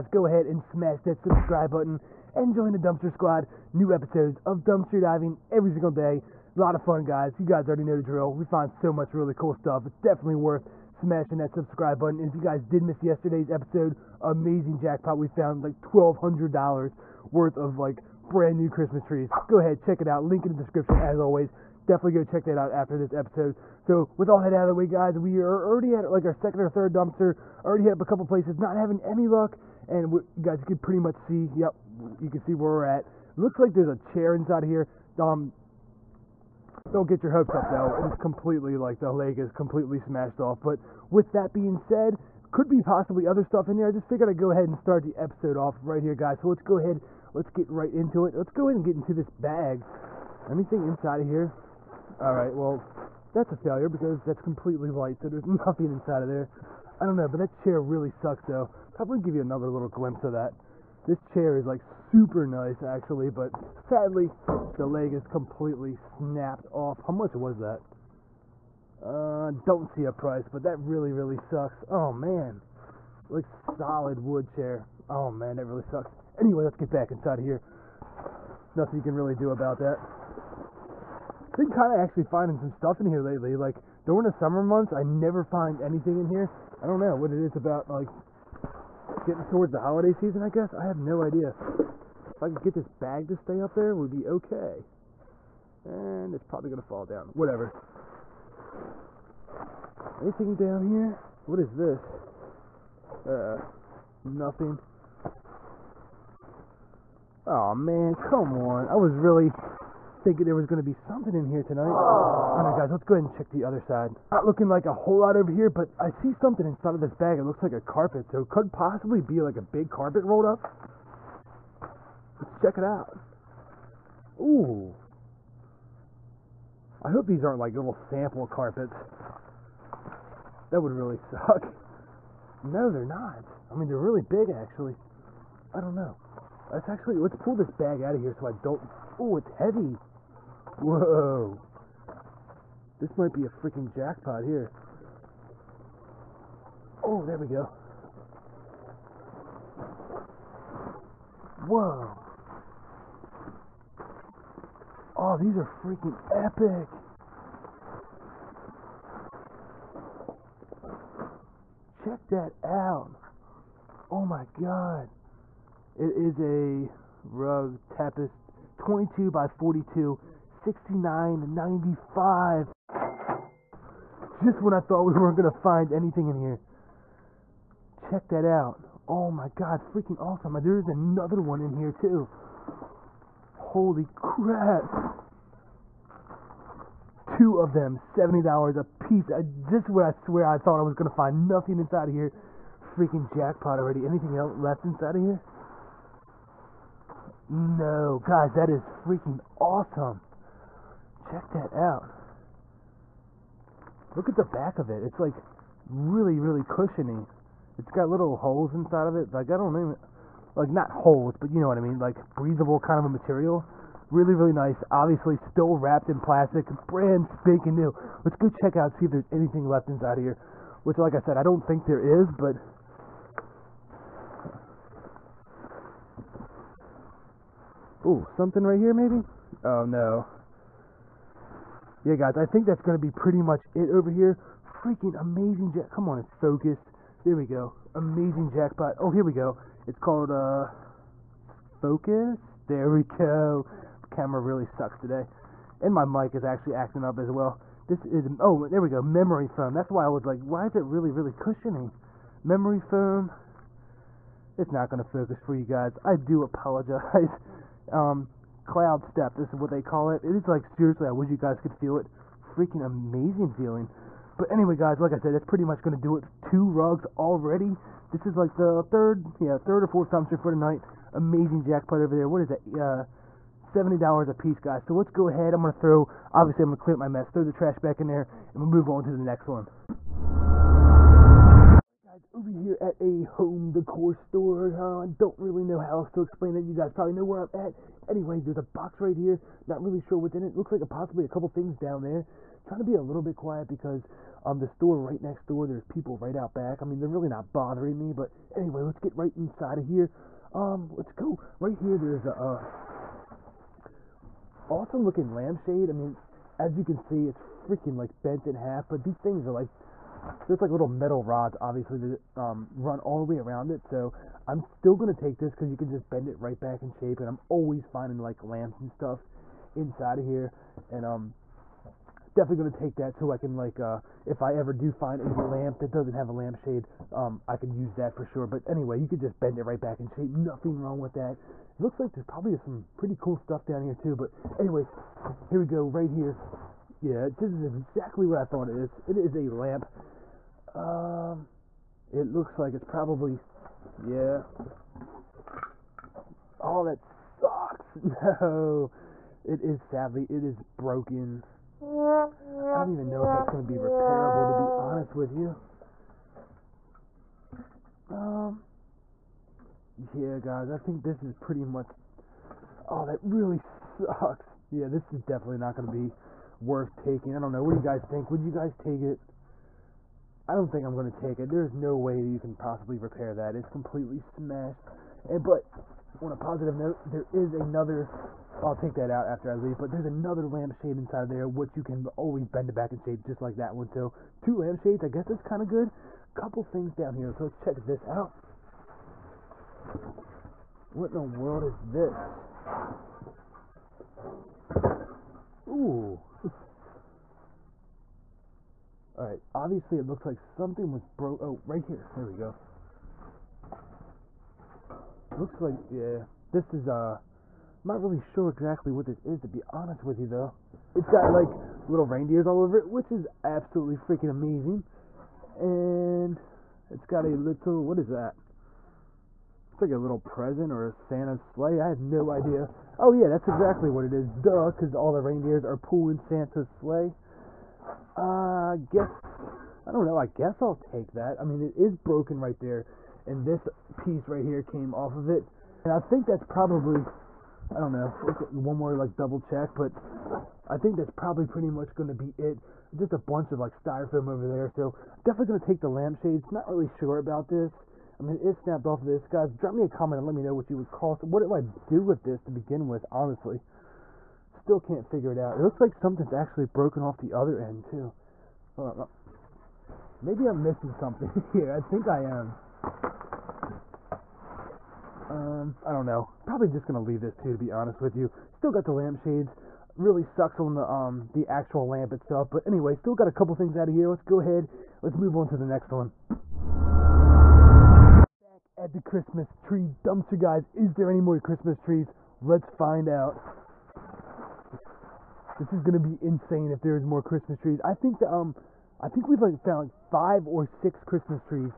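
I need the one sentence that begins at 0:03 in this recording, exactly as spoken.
New episodes of Dumpster Diving every single day.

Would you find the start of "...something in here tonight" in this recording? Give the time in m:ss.
1:50.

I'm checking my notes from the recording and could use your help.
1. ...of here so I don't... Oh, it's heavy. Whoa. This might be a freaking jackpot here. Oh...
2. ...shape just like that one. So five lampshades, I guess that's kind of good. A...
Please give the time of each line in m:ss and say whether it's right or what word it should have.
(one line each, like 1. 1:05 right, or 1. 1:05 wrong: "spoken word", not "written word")
1. 2:18 right
2. 6:23 wrong: "two", not "five".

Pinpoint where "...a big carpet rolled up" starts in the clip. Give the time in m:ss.
1:59.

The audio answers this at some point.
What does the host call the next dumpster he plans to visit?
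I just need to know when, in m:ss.
7:59.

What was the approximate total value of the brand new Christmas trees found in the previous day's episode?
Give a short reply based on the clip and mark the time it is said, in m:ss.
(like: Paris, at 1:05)
$1,200, at 0:15.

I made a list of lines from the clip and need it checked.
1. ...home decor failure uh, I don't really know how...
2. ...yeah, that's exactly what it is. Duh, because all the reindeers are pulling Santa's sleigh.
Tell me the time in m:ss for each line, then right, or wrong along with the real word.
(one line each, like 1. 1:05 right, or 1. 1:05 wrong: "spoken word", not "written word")
1. 4:43 wrong: "store", not "failure"
2. 7:03 right.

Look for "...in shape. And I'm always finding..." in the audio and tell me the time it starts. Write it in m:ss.
5:16.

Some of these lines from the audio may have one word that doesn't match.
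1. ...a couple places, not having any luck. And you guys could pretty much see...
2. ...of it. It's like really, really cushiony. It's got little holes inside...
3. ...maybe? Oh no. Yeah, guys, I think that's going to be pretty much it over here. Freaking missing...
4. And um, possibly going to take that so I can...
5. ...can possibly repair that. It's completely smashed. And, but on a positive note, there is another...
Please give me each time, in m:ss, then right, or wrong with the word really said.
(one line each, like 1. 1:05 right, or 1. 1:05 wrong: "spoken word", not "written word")
1. 0:28 right
2. 3:24 right
3. 3:48 wrong: "amazing", not "missing"
4. 5:20 wrong: "definitely", not "possibly"
5. 6:12 right.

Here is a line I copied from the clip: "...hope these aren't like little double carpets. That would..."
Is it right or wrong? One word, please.
wrong.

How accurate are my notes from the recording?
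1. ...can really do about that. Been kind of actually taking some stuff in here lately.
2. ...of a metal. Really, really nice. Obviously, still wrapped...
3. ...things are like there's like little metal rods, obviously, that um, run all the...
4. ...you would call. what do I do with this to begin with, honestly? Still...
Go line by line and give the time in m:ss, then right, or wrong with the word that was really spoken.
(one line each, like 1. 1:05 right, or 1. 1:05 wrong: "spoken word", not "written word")
1. 1:19 wrong: "finding", not "taking"
2. 3:32 wrong: "material", not "metal"
3. 5:09 right
4. 7:30 right.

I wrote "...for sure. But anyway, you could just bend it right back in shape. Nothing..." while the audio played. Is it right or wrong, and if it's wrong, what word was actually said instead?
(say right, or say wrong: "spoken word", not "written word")
right.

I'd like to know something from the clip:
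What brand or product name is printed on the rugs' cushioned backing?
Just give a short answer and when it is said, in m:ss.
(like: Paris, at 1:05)
Cloud Step, at 4:18.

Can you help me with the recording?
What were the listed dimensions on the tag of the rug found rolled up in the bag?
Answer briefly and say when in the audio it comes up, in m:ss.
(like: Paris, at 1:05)
22 by 42, at 2:48.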